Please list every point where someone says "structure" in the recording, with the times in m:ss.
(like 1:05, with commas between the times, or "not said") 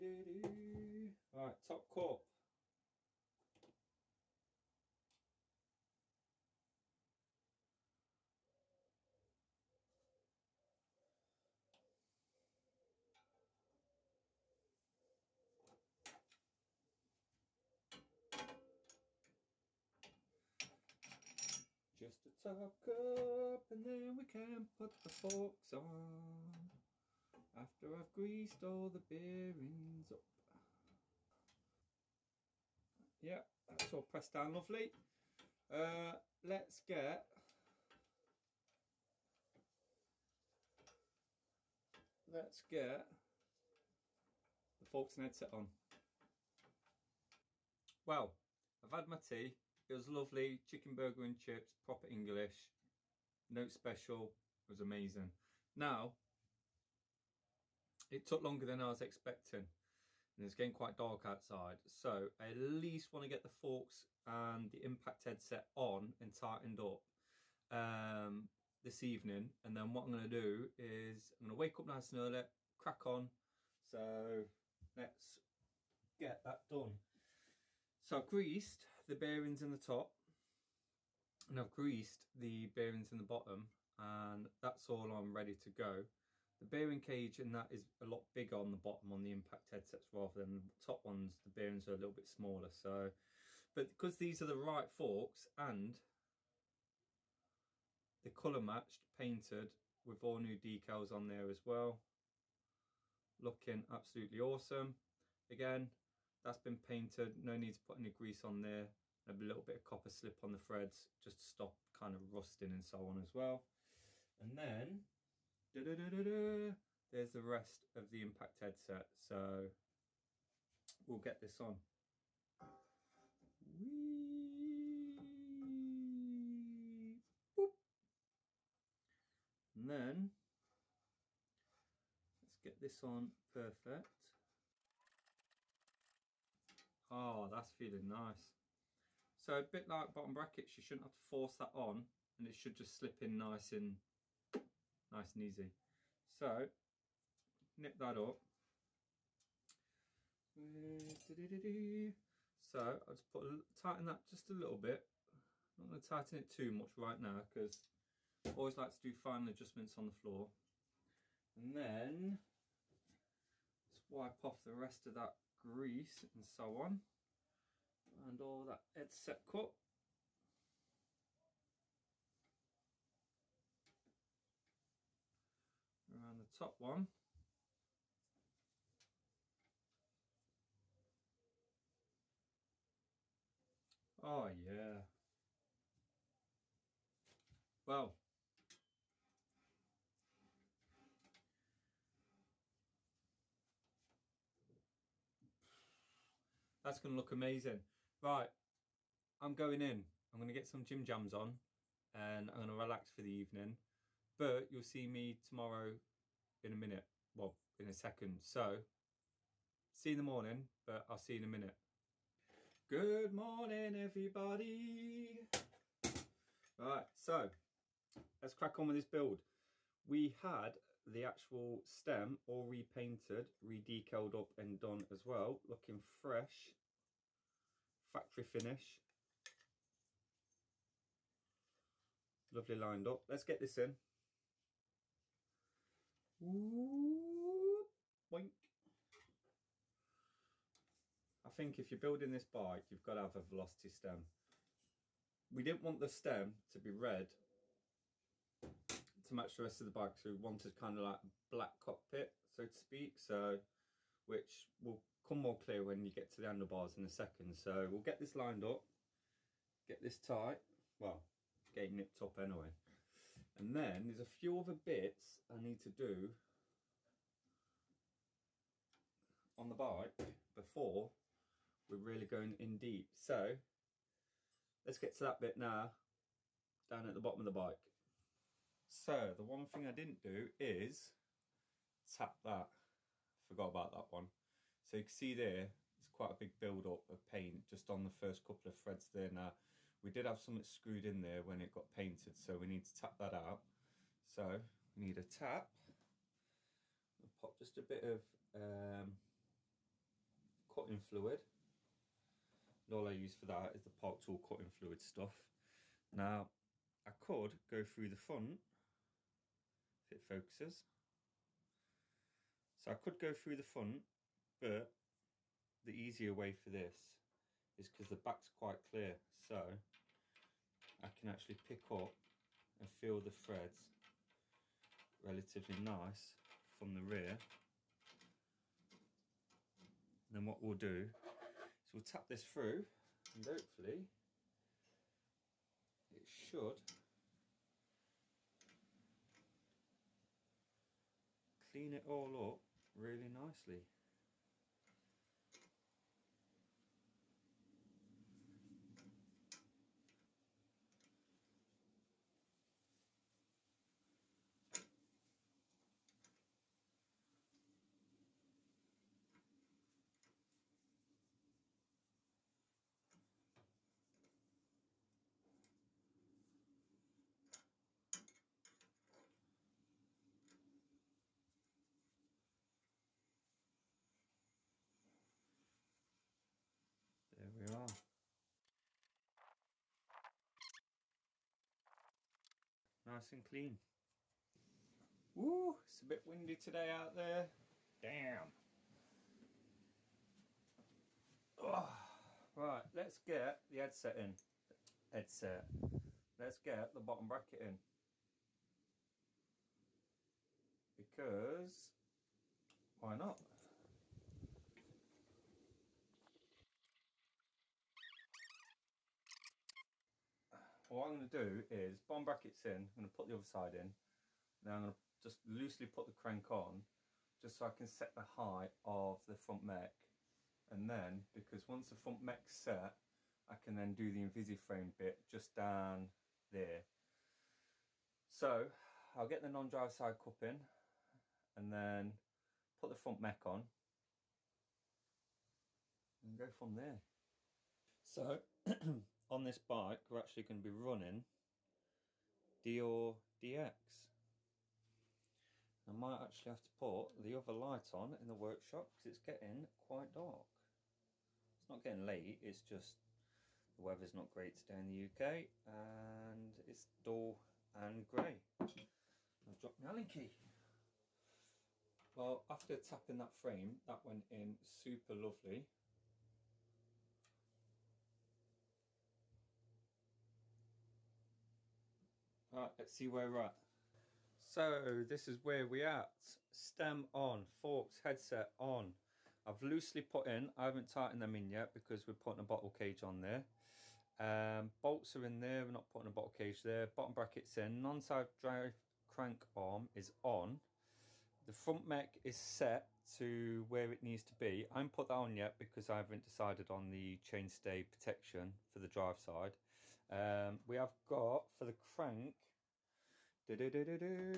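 not said.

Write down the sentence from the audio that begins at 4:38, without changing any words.
So the one thing I didn't do is tap that.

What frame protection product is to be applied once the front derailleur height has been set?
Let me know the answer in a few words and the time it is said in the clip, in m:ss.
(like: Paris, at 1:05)
Invisiframe, at 7:04.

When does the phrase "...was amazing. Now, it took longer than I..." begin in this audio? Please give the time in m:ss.
0:54.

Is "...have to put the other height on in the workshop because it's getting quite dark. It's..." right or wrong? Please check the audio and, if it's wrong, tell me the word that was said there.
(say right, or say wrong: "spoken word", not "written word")
wrong: "light", not "height".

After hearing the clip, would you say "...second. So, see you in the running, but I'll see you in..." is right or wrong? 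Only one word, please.
wrong.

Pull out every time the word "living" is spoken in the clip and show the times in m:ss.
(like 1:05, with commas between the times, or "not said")
not said.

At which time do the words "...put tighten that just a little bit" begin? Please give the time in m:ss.
2:33.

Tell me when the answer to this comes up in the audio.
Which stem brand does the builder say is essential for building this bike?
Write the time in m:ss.
4:03.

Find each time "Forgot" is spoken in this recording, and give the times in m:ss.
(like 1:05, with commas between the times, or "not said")
4:43.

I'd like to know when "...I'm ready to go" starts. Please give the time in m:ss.
1:25.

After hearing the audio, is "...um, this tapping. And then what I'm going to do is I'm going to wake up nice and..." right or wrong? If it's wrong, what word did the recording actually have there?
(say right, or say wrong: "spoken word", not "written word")
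wrong: "evening", not "tapping".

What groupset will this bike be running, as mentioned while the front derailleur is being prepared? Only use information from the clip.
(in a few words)
Deore DX.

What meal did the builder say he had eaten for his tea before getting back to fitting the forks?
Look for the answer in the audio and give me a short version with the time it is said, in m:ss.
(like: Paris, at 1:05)
Chicken burger and chips, at 0:50.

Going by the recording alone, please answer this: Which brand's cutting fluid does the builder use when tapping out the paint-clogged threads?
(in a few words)
Park Tool.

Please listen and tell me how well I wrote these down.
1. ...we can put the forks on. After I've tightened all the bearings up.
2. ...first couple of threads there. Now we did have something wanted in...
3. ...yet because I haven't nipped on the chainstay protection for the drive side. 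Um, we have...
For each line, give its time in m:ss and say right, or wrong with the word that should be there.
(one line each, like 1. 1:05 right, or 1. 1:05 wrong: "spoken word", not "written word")
1. 0:24 wrong: "greased", not "tightened"
2. 4:48 wrong: "screwed", not "wanted"
3. 8:15 wrong: "decided", not "nipped".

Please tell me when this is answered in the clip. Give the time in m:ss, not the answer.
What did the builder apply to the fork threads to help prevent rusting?
1:49.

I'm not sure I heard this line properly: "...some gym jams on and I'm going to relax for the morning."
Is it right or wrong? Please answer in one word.
wrong.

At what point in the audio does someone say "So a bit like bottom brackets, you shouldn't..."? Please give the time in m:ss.
2:19.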